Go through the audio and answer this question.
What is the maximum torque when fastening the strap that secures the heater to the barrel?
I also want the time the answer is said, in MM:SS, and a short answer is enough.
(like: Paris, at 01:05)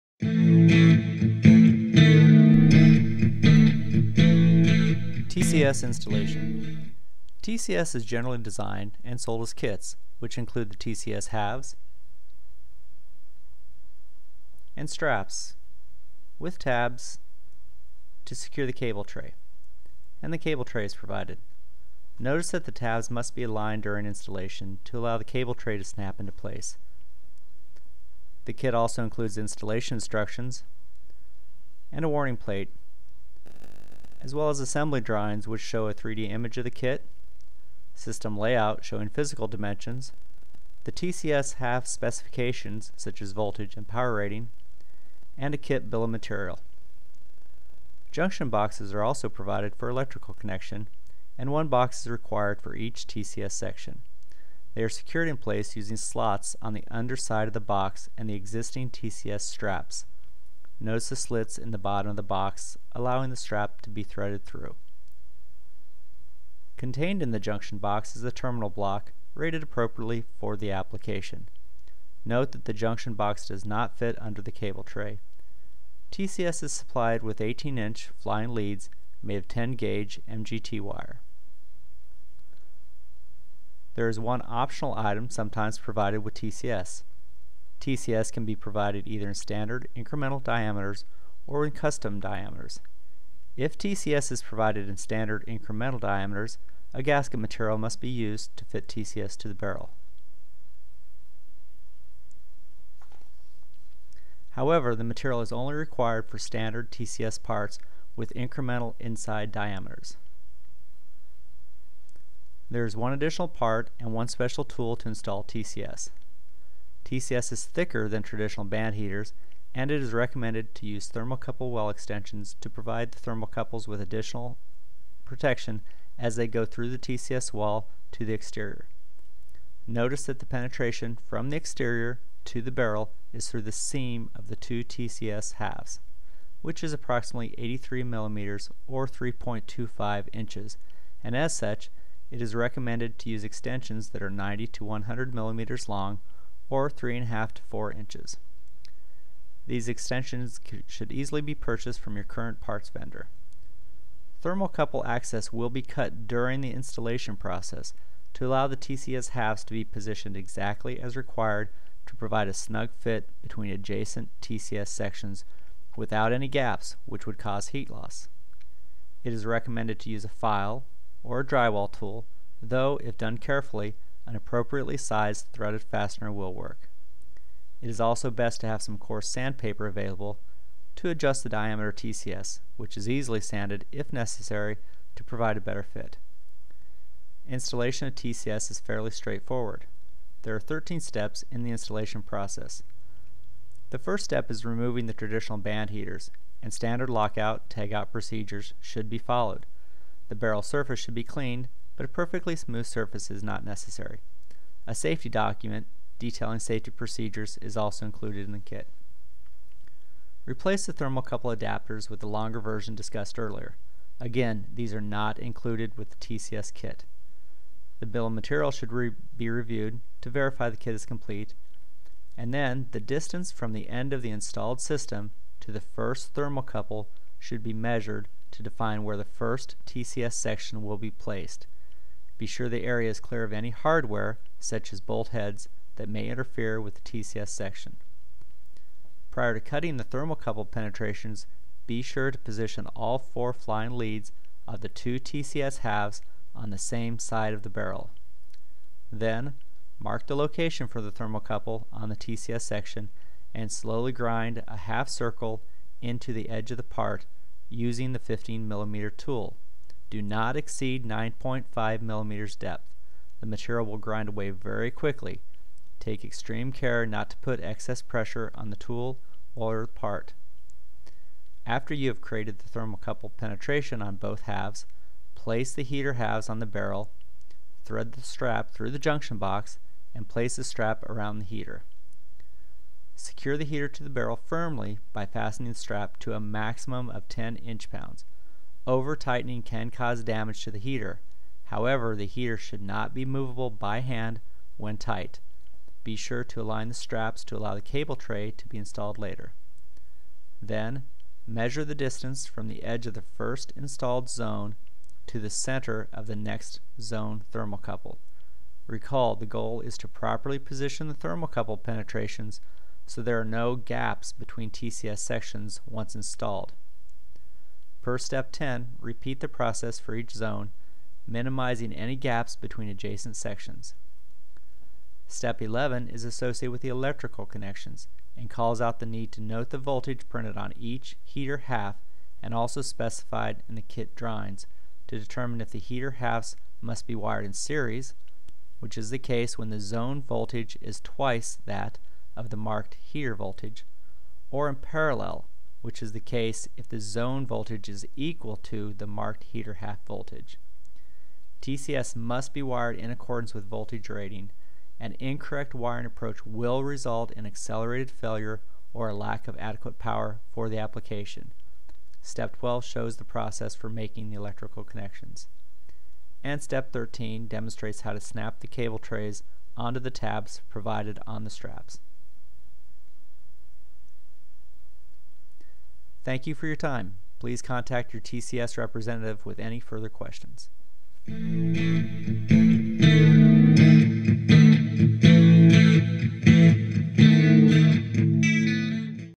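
10 inch-pounds, at 04:47.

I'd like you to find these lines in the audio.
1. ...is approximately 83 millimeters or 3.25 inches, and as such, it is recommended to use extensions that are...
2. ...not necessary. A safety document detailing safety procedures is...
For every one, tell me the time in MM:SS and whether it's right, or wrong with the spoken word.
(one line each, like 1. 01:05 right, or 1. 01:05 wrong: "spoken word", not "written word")
1. 02:16 right
2. 03:23 right.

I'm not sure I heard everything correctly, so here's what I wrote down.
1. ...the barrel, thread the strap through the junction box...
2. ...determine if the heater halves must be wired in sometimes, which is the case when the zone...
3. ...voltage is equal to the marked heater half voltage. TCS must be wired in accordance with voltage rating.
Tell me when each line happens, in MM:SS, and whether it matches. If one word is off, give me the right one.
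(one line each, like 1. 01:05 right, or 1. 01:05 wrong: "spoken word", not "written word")
1. 04:36 right
2. 05:35 wrong: "series", not "sometimes"
3. 05:47 right.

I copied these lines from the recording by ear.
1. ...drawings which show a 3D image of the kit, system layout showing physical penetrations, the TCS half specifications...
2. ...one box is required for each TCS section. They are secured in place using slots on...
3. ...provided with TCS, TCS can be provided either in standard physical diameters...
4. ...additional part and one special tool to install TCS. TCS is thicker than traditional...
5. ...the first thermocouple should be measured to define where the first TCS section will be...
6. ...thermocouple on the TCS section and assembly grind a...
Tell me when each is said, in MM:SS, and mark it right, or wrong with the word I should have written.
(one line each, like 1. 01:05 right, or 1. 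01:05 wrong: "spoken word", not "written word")
1. 00:35 wrong: "dimensions", not "penetrations"
2. 00:51 right
3. 01:25 wrong: "incremental", not "physical"
4. 01:53 right
5. 03:45 right
6. 04:11 wrong: "slowly", not "assembly".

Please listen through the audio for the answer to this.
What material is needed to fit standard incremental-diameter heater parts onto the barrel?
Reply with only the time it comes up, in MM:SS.
01:37.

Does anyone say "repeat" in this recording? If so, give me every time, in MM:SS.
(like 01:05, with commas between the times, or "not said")
05:18.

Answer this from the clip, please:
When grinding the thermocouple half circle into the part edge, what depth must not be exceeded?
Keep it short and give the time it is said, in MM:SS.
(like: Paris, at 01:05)
9.5 millimeters, at 04:21.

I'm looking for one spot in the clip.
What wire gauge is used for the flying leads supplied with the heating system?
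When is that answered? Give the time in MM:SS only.
01:19.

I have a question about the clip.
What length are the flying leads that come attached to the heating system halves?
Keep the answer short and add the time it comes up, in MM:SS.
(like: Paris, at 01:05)
18-inch, at 01:17.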